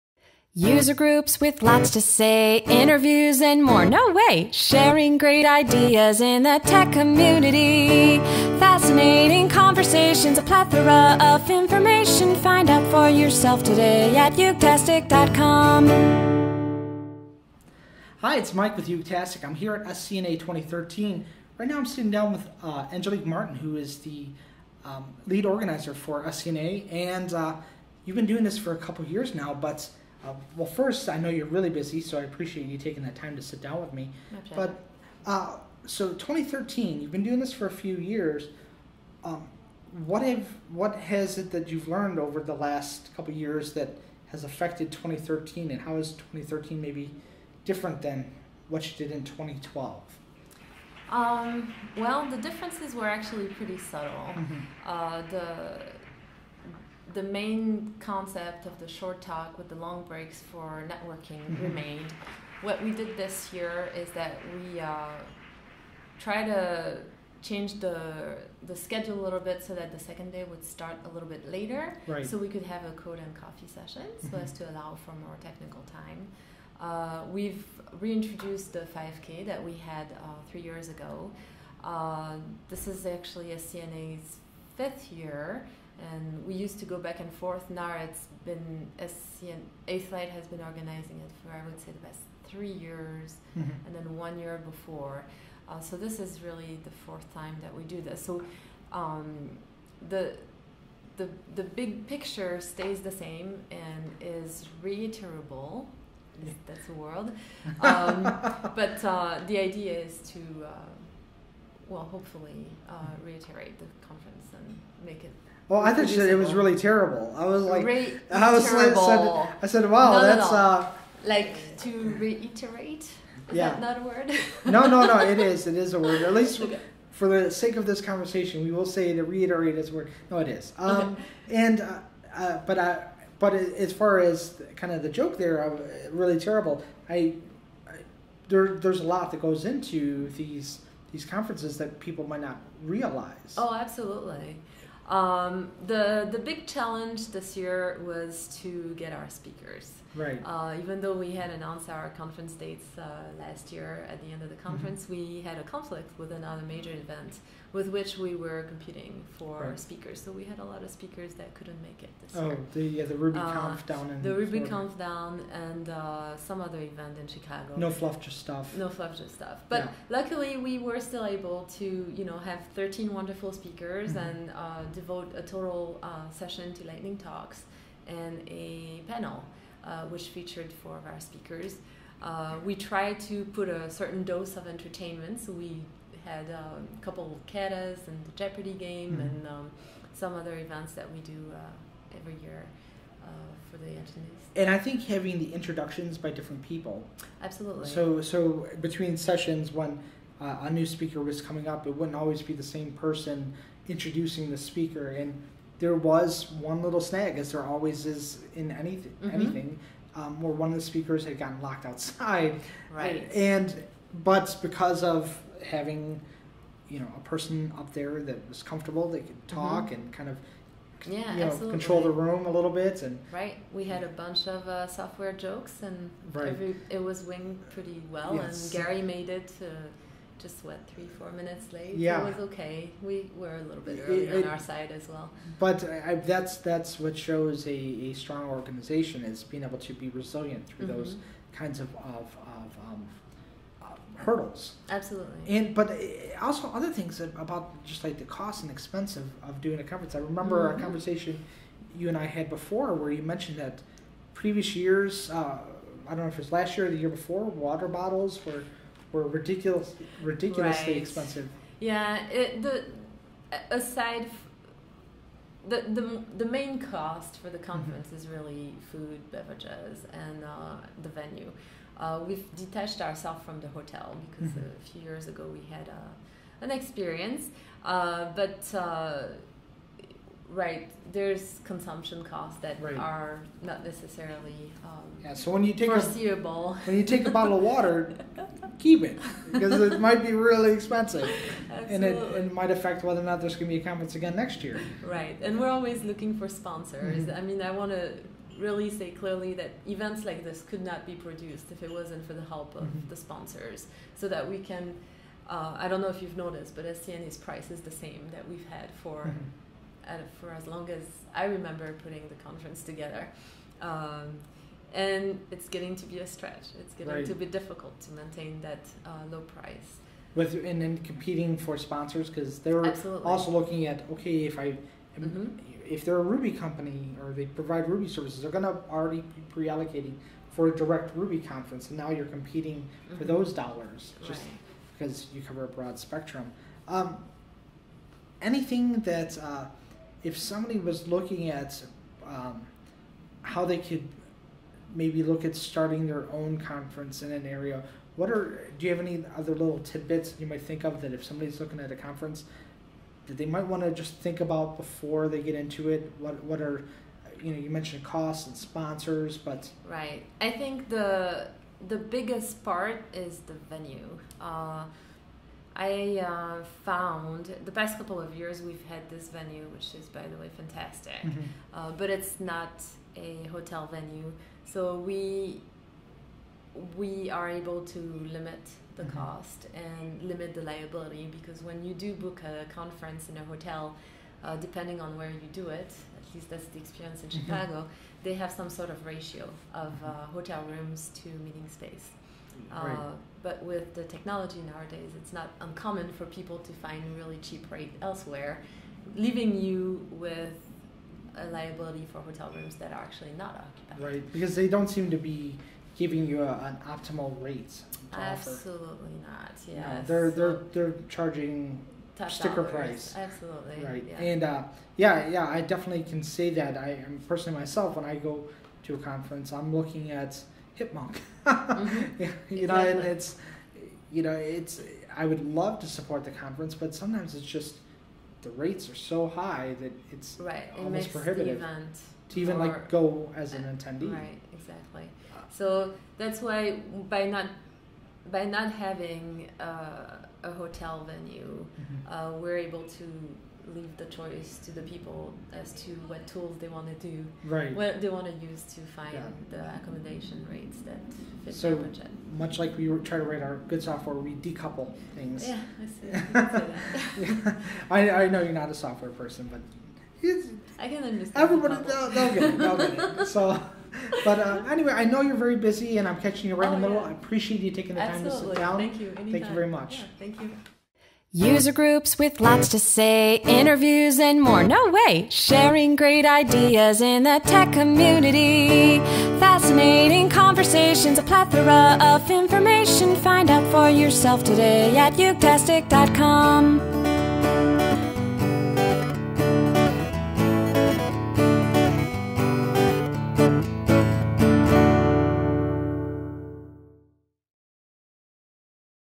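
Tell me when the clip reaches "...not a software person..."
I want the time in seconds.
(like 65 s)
458 s.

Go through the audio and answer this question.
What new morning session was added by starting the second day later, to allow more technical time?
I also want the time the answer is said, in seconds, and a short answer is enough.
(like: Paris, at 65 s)
code and coffee, at 72 s.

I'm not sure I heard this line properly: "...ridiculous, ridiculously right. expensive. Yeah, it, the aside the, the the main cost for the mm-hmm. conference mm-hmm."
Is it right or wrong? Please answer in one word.
right.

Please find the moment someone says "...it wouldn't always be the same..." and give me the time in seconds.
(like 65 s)
201 s.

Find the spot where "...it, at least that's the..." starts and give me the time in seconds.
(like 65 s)
385 s.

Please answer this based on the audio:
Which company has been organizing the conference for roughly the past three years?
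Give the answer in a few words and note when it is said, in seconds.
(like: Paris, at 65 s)
8th Light, at 89 s.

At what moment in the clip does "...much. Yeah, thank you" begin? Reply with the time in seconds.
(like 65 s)
469 s.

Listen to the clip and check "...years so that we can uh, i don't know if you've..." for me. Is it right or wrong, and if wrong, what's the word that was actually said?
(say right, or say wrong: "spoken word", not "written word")
wrong: "sponsors", not "years".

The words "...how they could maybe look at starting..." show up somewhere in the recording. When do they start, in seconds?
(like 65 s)
343 s.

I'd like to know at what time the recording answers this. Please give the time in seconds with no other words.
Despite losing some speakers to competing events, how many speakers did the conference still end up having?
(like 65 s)
172 s.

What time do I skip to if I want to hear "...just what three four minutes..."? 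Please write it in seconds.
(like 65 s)
230 s.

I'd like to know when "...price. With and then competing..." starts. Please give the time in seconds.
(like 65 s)
319 s.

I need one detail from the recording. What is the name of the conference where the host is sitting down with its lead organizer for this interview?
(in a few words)
SCNA 2013.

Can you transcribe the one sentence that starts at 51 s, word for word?
Um, well, the differences were actually pretty subtle.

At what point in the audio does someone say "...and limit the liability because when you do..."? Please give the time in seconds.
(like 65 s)
379 s.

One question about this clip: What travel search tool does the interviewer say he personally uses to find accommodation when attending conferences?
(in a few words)
Hipmunk.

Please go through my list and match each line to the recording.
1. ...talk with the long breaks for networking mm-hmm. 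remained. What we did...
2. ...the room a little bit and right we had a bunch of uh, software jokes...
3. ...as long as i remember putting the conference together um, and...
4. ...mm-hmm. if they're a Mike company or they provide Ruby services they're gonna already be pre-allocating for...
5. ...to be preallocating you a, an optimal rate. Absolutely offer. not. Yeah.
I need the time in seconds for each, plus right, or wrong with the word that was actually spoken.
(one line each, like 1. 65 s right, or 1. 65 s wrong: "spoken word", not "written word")
1. 59 s right
2. 222 s right
3. 310 s right
4. 325 s wrong: "Ruby", not "Mike"
5. 405 s wrong: "giving", not "preallocating".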